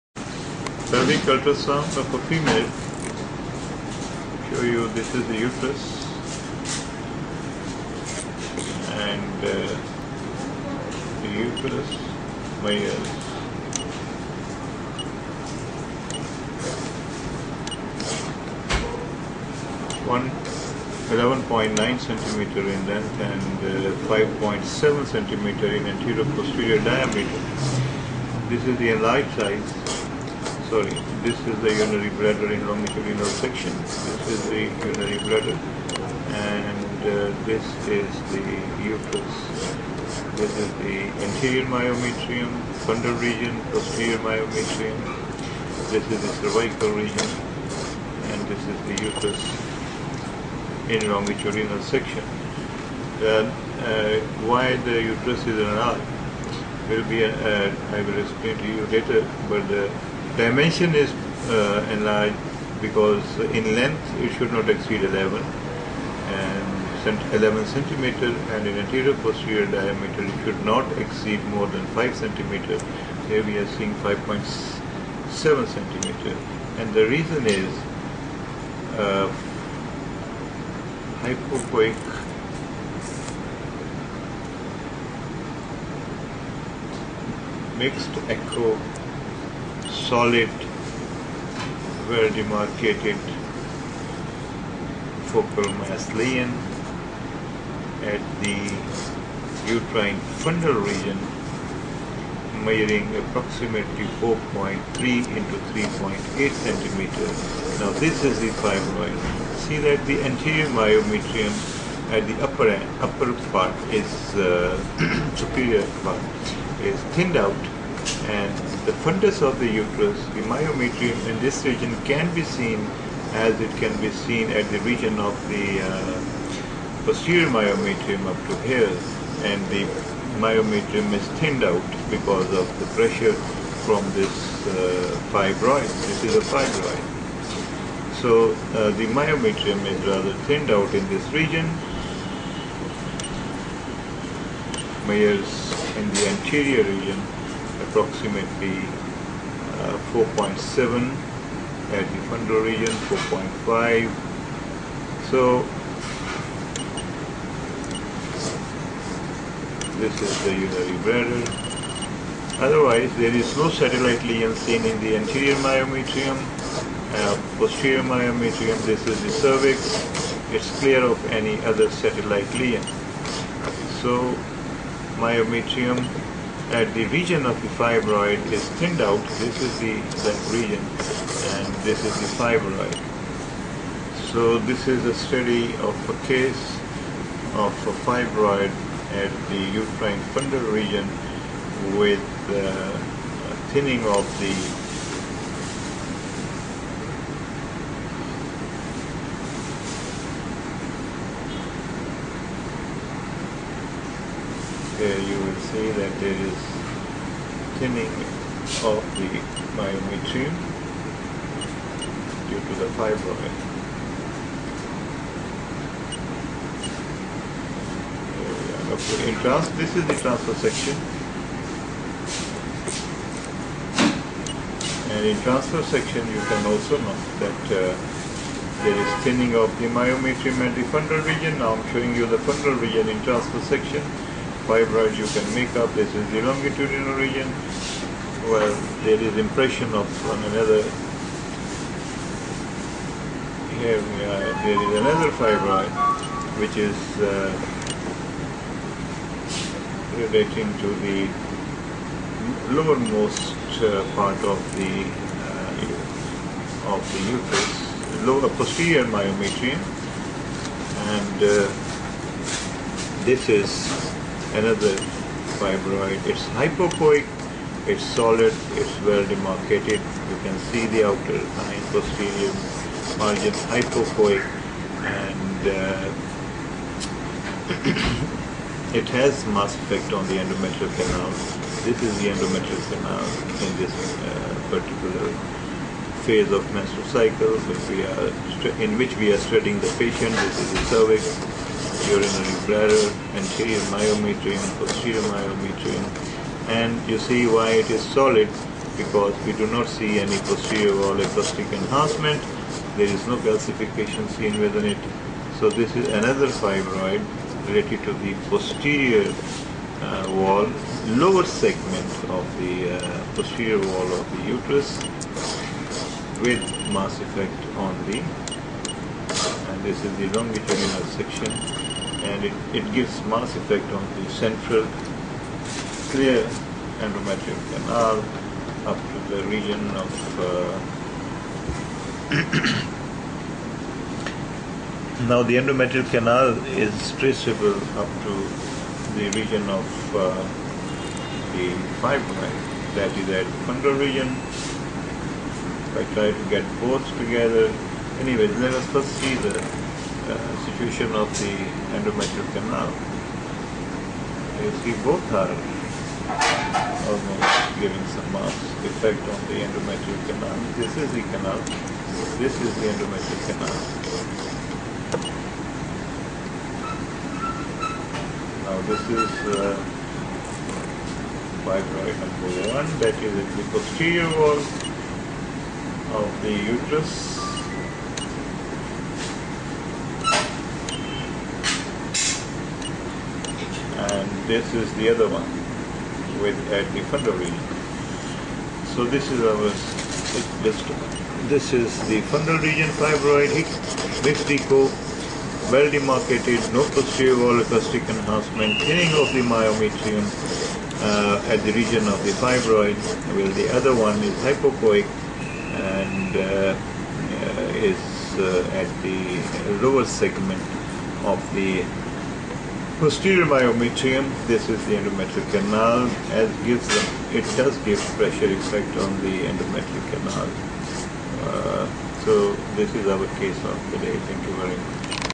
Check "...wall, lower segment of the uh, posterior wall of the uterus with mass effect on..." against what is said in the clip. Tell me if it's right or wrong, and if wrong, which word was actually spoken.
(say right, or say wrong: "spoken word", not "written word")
right.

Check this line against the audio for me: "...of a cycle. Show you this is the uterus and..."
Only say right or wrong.
wrong.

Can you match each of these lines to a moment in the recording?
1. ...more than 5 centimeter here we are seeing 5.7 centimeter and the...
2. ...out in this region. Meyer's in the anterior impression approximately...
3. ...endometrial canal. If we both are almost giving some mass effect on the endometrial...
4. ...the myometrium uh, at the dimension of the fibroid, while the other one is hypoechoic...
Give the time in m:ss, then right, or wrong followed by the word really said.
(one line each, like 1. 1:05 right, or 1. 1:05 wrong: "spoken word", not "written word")
1. 1:11 right
2. 2:20 wrong: "region", not "impression"
3. 5:51 right
4. 6:39 wrong: "region", not "dimension".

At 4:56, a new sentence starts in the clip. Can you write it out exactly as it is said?
And you see why it is solid, because we do not see any posterior wall acoustic enhancement.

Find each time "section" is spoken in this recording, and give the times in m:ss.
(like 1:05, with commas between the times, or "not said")
0:33, 0:51, 3:40, 3:45, 3:53, 5:21.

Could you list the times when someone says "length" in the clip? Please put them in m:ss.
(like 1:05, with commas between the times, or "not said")
0:22, 1:03.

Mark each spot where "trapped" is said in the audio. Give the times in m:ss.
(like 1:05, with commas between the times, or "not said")
not said.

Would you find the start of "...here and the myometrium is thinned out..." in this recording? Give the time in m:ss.
2:08.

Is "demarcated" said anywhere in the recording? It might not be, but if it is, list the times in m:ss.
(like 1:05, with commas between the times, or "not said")
1:32, 4:29, 6:35.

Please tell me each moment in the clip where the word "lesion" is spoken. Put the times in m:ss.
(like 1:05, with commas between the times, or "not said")
1:36, 2:44, 2:52.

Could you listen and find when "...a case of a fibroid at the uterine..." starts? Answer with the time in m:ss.
3:06.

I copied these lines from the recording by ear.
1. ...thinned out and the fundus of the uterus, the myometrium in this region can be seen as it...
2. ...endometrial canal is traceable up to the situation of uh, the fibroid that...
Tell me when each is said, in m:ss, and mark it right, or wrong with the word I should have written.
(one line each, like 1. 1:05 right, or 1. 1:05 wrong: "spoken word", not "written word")
1. 1:57 right
2. 5:35 wrong: "region", not "situation".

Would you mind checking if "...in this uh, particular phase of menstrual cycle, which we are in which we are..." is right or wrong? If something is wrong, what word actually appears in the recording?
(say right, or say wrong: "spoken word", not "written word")
right.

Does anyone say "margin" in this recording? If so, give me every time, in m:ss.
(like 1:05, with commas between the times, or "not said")
4:33.